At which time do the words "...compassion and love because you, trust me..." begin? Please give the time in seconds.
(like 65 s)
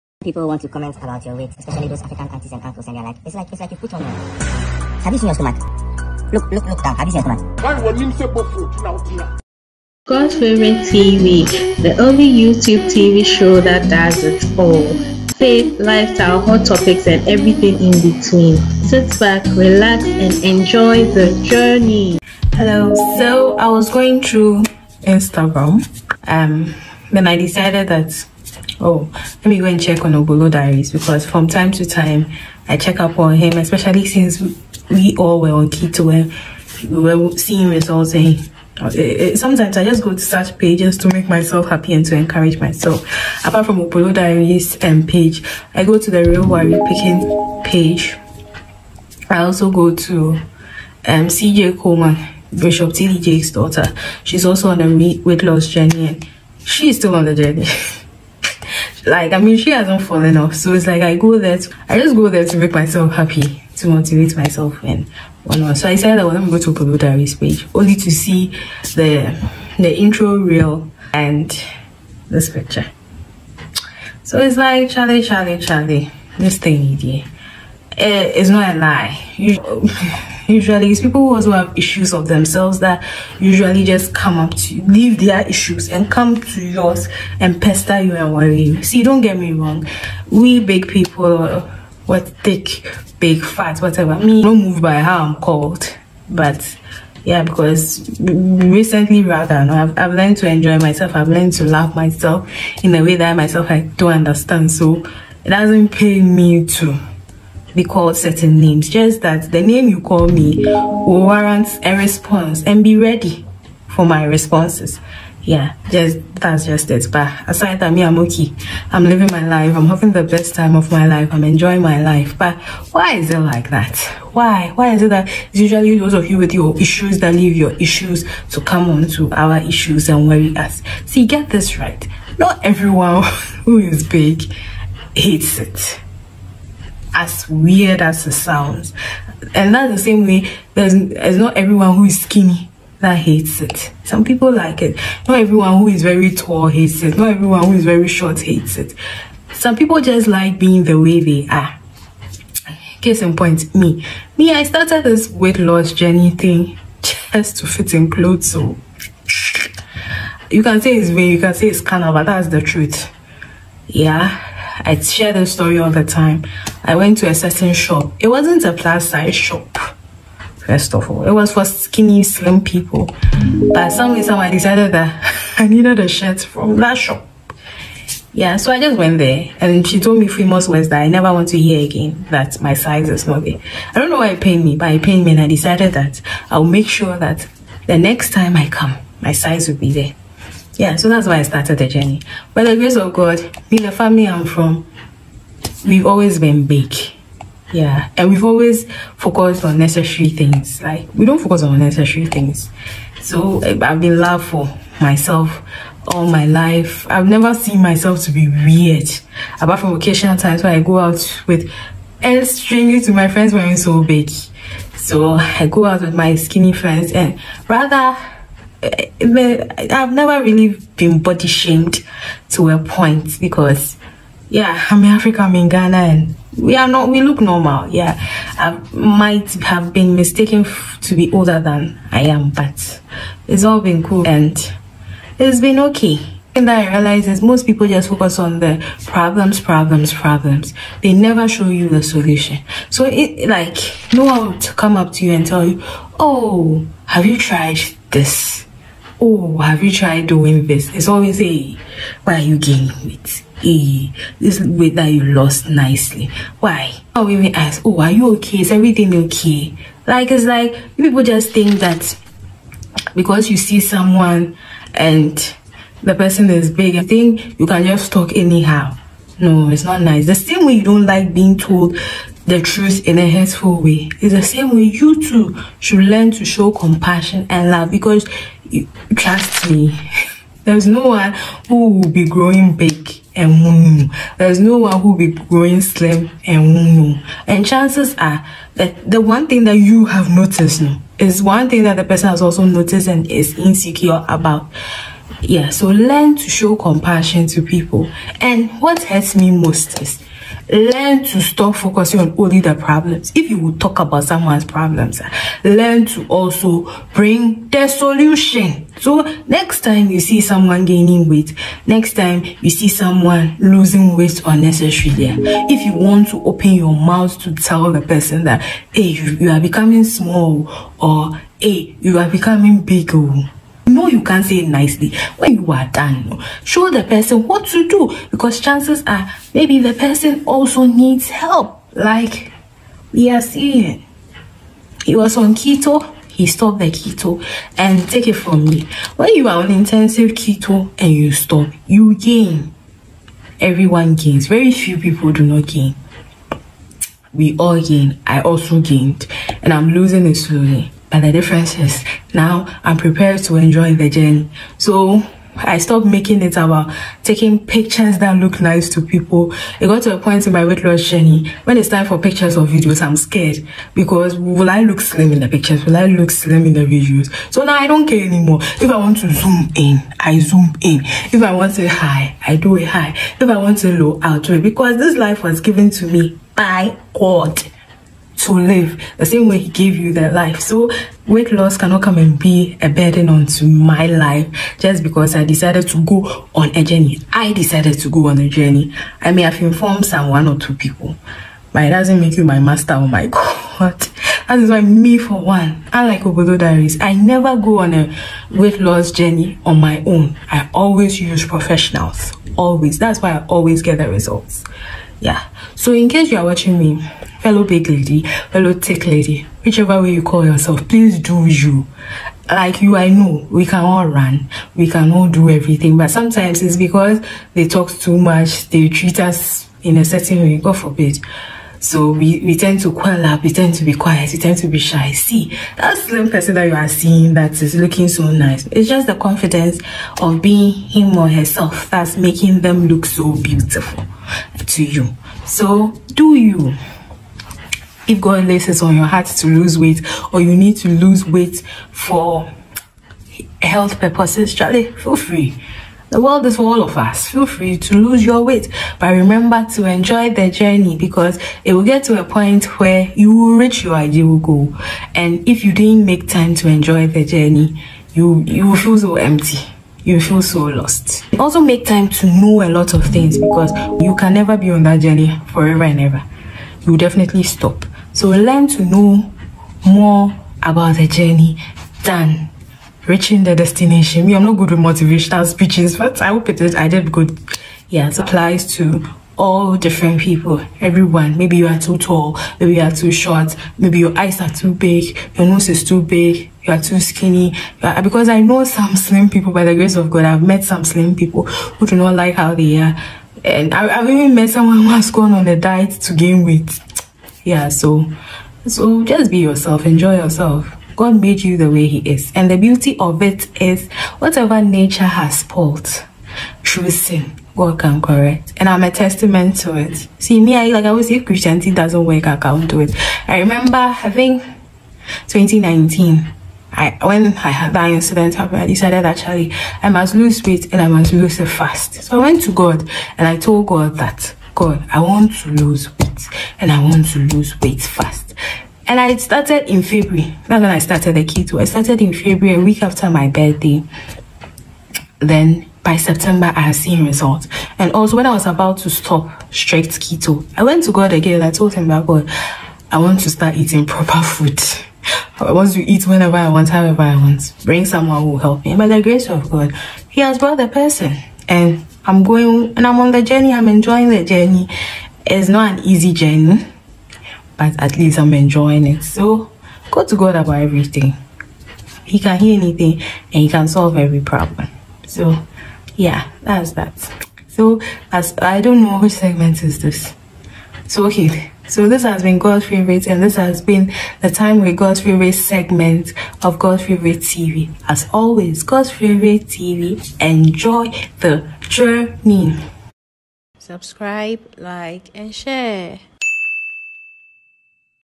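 276 s.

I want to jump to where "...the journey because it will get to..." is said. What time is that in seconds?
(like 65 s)
450 s.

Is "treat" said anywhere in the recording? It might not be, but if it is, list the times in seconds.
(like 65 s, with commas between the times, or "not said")
418 s.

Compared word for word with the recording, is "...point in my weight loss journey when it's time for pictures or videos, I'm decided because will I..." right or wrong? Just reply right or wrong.
wrong.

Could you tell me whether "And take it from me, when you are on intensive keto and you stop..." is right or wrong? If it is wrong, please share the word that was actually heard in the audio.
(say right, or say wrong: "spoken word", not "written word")
right.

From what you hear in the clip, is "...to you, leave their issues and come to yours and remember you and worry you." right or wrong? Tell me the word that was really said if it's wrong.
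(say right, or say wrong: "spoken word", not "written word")
wrong: "pester", not "remember".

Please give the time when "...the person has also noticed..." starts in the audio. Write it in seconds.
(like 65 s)
291 s.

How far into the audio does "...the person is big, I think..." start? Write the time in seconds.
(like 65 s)
266 s.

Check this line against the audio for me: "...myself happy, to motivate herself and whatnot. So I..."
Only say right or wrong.
wrong.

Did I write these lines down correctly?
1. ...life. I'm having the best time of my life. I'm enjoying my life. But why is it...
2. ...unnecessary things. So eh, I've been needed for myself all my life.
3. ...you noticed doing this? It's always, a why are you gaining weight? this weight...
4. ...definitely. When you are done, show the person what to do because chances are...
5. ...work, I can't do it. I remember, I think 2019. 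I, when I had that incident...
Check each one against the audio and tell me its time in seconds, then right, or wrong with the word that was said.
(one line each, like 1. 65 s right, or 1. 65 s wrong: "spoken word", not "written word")
1. 119 s right
2. 201 s wrong: "loved", not "needed"
3. 249 s wrong: "tried", not "noticed"
4. 324 s wrong: "nicely", not "definitely"
5. 512 s right.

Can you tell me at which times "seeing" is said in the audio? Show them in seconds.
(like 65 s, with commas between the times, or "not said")
37 s, 333 s, 426 s.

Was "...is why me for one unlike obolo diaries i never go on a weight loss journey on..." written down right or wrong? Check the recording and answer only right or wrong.
right.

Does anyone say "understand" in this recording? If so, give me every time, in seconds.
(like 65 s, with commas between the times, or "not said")
104 s.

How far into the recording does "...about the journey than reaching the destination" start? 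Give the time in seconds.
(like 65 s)
470 s.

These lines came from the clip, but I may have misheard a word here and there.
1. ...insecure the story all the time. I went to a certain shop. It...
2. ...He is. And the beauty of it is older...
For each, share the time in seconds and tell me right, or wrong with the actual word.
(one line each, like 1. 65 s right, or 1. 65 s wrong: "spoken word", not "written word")
1. 164 s wrong: "share", not "insecure"
2. 501 s wrong: "whatever", not "older".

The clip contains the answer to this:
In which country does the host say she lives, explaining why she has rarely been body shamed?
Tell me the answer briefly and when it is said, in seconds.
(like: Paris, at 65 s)
Ghana, at 225 s.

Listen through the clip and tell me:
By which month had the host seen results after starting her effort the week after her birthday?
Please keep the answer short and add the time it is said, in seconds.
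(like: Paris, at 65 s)
September, at 535 s.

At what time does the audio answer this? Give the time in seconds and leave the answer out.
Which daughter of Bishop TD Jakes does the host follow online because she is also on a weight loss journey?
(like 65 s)
51 s.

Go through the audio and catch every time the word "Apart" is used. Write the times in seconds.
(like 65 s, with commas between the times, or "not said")
43 s, 209 s.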